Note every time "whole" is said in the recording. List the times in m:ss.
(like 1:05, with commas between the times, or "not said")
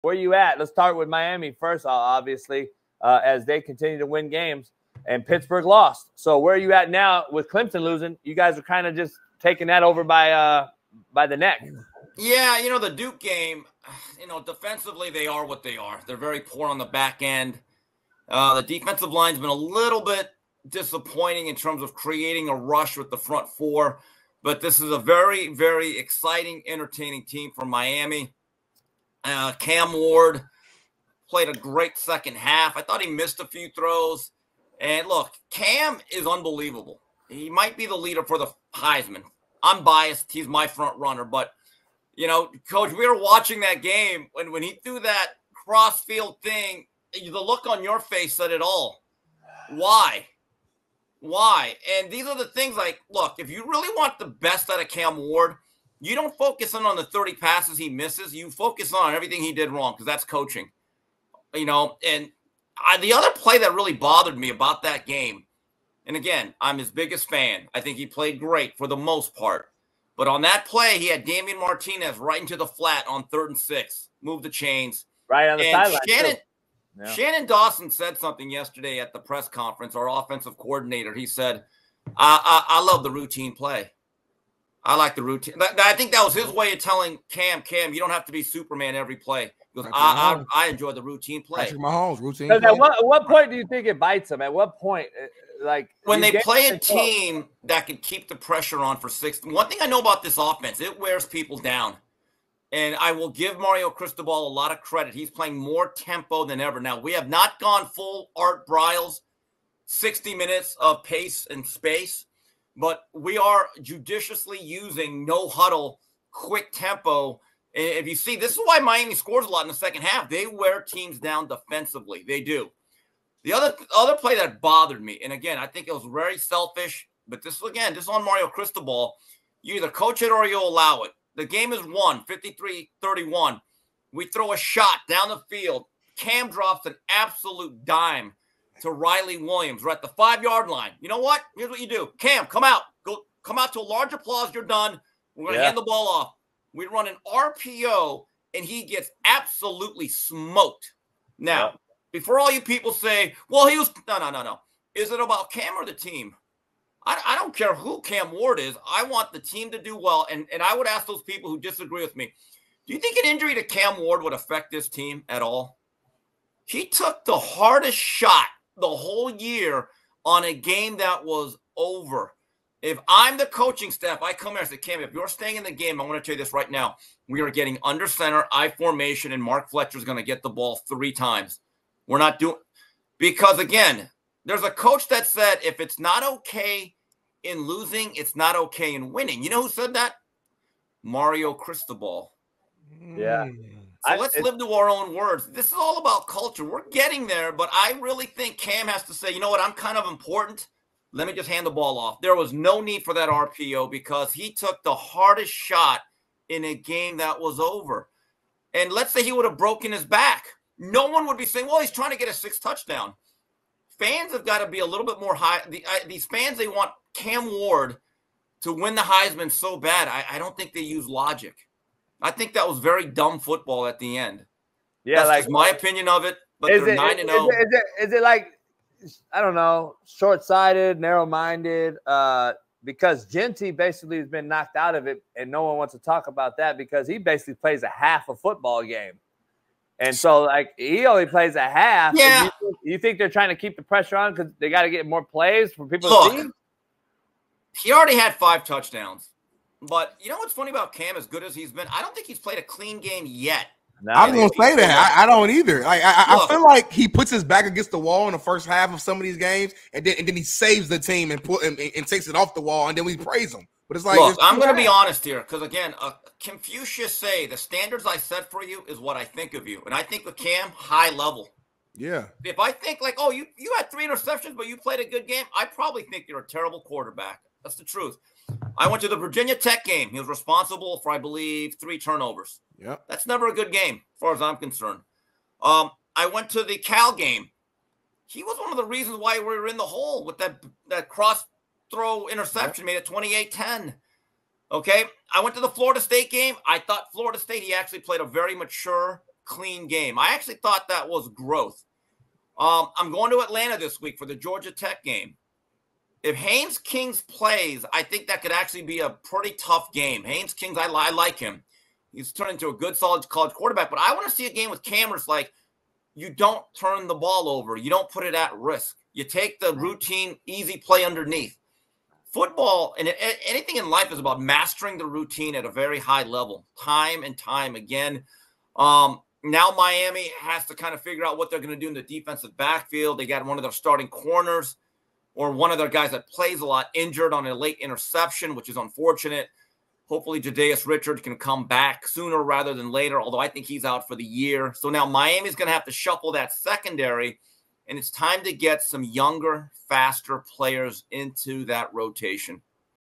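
2:48.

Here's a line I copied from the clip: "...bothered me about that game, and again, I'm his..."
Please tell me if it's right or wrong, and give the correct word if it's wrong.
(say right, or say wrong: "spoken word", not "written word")
right.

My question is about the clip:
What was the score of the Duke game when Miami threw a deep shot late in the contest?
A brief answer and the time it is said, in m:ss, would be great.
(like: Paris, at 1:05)
53-31, at 2:12.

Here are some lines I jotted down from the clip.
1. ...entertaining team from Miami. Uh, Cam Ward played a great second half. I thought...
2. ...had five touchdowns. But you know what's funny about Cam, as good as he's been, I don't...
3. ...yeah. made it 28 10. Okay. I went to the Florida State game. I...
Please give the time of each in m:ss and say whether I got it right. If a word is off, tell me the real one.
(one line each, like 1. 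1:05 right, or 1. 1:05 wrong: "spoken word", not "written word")
1. 0:26 right
2. 4:08 right
3. 4:52 right.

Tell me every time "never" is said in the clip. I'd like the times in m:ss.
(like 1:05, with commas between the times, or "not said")
4:43.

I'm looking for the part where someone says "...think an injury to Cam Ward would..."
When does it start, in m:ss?
2:42.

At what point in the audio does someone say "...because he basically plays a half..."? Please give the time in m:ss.
3:56.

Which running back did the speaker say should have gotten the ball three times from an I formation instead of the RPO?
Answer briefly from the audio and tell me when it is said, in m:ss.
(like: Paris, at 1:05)
Mark Fletcher, at 2:59.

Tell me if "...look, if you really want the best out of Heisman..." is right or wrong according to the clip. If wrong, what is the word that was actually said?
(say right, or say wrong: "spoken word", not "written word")
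wrong: "Cam", not "Heisman".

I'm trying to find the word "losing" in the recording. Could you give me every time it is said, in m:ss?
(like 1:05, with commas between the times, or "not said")
0:07, 3:07.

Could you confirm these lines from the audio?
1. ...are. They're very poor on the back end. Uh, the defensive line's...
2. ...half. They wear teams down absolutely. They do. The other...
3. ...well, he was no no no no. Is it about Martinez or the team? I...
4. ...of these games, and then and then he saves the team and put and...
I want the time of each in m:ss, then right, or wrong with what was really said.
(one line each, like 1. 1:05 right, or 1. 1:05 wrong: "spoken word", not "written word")
1. 0:15 right
2. 2:00 wrong: "defensively", not "absolutely"
3. 2:33 wrong: "Cam", not "Martinez"
4. 4:19 right.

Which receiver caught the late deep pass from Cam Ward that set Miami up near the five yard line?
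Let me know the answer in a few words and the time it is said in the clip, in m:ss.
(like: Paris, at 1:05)
Riley Williams, at 2:18.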